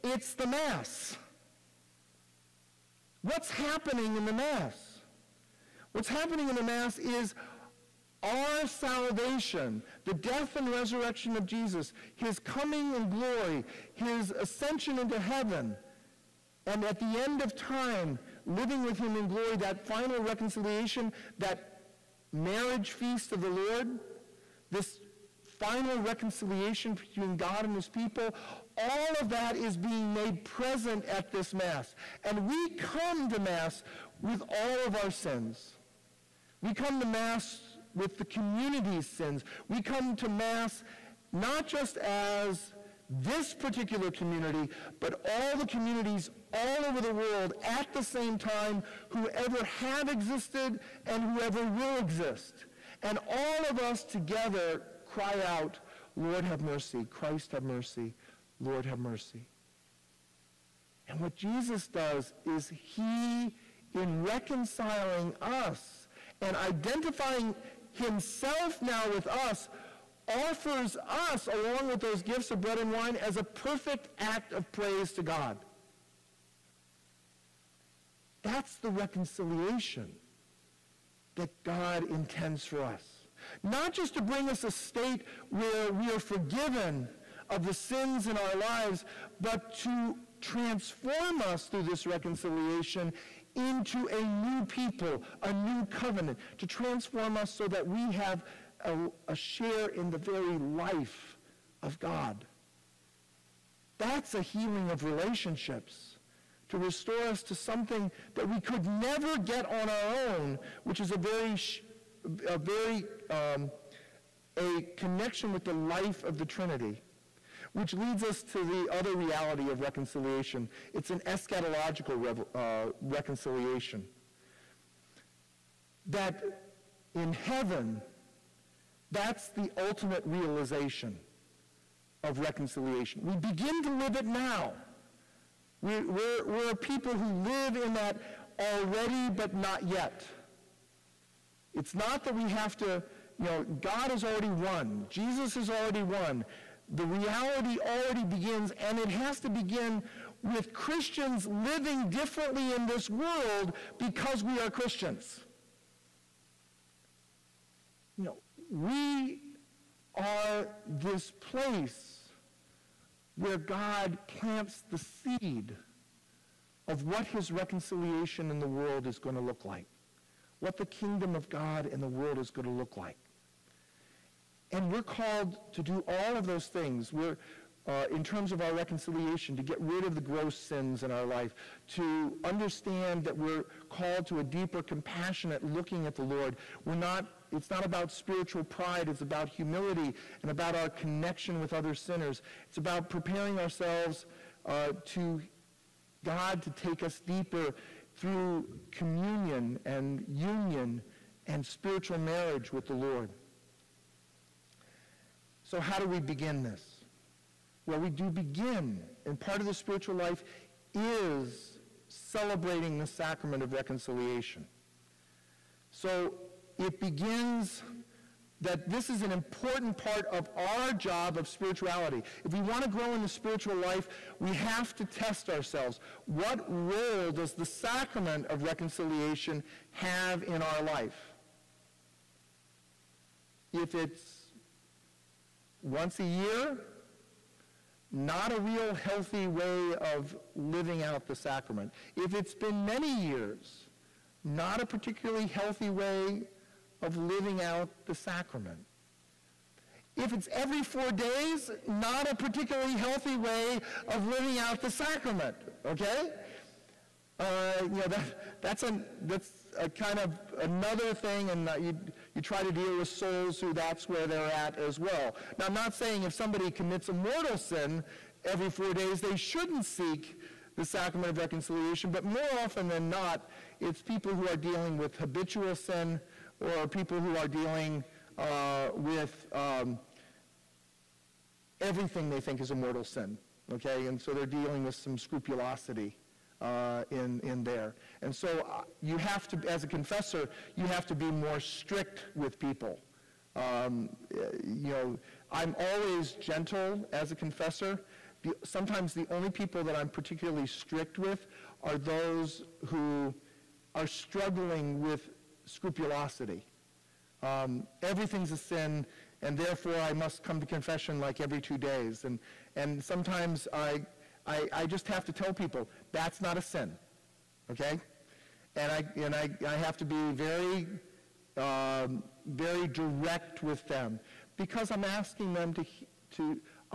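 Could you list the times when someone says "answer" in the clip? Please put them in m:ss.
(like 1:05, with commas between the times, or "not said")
not said.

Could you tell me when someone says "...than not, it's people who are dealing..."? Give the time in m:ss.
4:32.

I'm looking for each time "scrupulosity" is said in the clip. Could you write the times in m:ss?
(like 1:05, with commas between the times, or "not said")
4:45, 5:05.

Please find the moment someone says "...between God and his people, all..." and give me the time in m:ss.
0:26.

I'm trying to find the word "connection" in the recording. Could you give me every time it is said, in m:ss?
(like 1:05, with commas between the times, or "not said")
1:54, 3:10.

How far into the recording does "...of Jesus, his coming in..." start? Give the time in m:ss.
0:11.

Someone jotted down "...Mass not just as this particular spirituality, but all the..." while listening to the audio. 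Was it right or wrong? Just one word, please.
wrong.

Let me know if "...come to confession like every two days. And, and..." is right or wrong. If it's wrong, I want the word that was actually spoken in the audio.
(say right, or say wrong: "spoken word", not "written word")
right.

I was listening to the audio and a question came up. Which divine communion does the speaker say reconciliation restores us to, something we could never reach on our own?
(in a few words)
the Trinity.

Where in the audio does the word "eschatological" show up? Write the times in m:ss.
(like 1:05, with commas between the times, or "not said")
2:01.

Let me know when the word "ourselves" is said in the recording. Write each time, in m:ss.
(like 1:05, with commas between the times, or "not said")
3:13, 3:45.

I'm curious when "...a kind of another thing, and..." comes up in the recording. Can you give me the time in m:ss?
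4:19.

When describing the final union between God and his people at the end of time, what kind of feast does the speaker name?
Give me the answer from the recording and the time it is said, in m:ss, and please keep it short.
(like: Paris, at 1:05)
marriage feast, at 0:22.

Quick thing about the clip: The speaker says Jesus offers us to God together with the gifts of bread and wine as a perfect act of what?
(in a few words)
praise.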